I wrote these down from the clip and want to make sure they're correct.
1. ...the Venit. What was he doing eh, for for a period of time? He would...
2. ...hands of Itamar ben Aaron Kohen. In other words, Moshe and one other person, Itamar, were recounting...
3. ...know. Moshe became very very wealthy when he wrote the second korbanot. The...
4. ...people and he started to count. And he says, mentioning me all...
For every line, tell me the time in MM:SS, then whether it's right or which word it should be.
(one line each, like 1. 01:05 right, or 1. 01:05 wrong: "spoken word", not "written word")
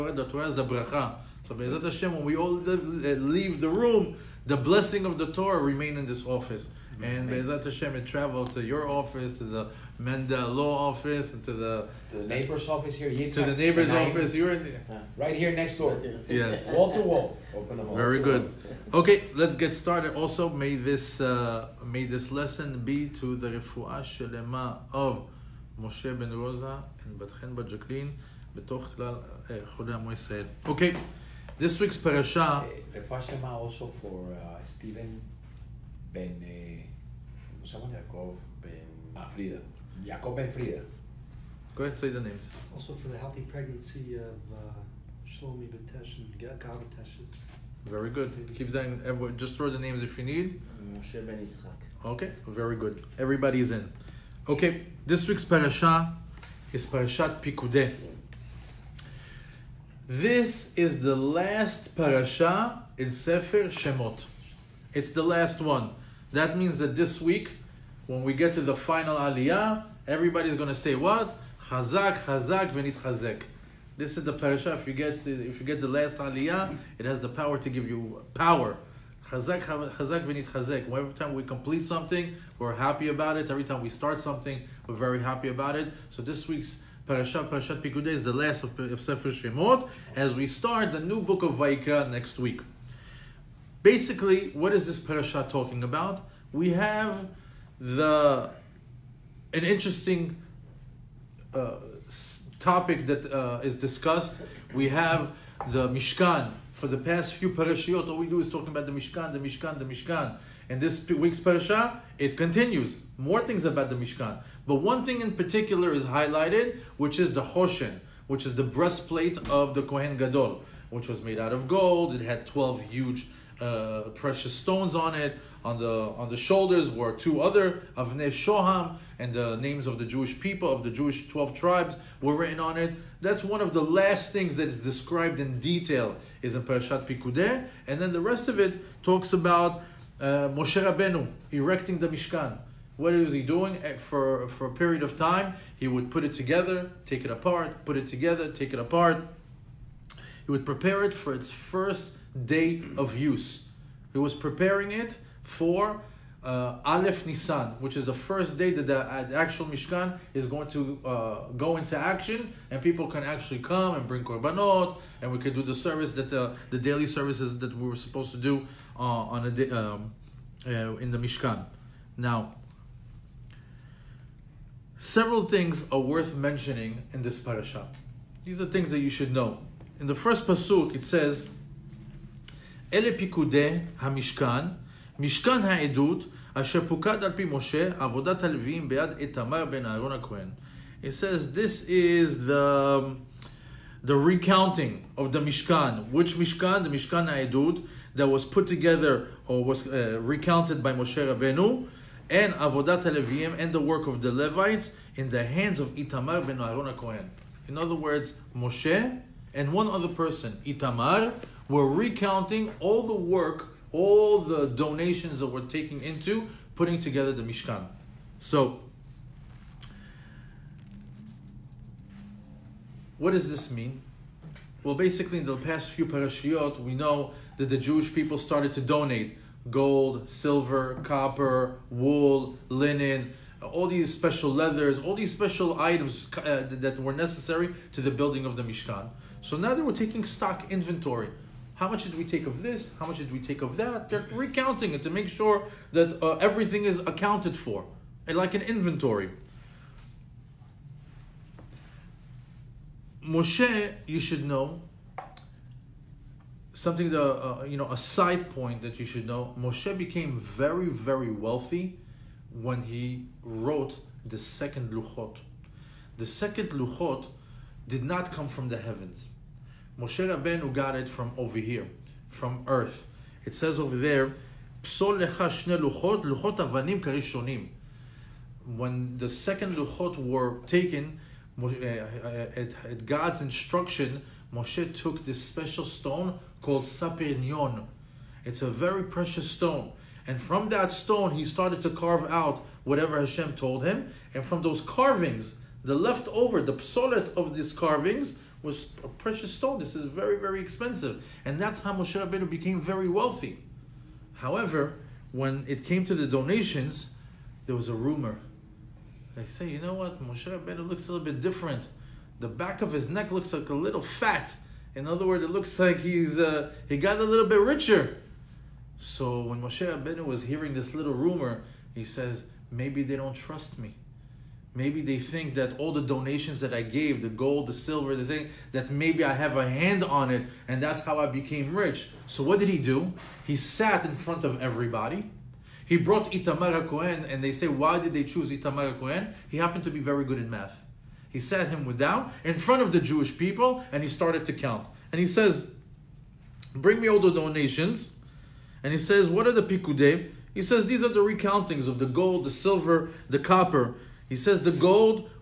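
1. 02:21 wrong: "Mishkan", not "Venit"
2. 03:25 right
3. 04:19 wrong: "luchot", not "korbanot"
4. 05:43 wrong: "bring", not "mentioning".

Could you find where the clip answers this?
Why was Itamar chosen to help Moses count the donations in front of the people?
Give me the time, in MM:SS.
05:39.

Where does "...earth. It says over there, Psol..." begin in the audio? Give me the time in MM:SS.
04:32.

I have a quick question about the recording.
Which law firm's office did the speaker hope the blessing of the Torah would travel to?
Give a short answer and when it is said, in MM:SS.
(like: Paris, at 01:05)
Mendel Law office, at 00:09.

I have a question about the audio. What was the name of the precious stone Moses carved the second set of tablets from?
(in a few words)
sapirnion.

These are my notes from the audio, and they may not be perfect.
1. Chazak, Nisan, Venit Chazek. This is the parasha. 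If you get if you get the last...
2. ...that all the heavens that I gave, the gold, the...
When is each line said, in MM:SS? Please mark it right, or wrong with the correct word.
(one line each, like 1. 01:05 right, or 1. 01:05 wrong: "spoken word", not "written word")
1. 01:11 wrong: "Chazak", not "Nisan"
2. 05:25 wrong: "donations", not "heavens".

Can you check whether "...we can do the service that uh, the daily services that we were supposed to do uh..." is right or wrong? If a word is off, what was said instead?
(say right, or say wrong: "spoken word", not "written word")
right.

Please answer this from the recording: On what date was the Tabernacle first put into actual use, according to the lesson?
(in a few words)
Aleph Nisan.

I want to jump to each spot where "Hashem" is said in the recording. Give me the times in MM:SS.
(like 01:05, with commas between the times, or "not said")
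00:01, 00:07, 04:53.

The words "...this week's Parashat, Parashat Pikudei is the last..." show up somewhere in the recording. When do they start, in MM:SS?
01:26.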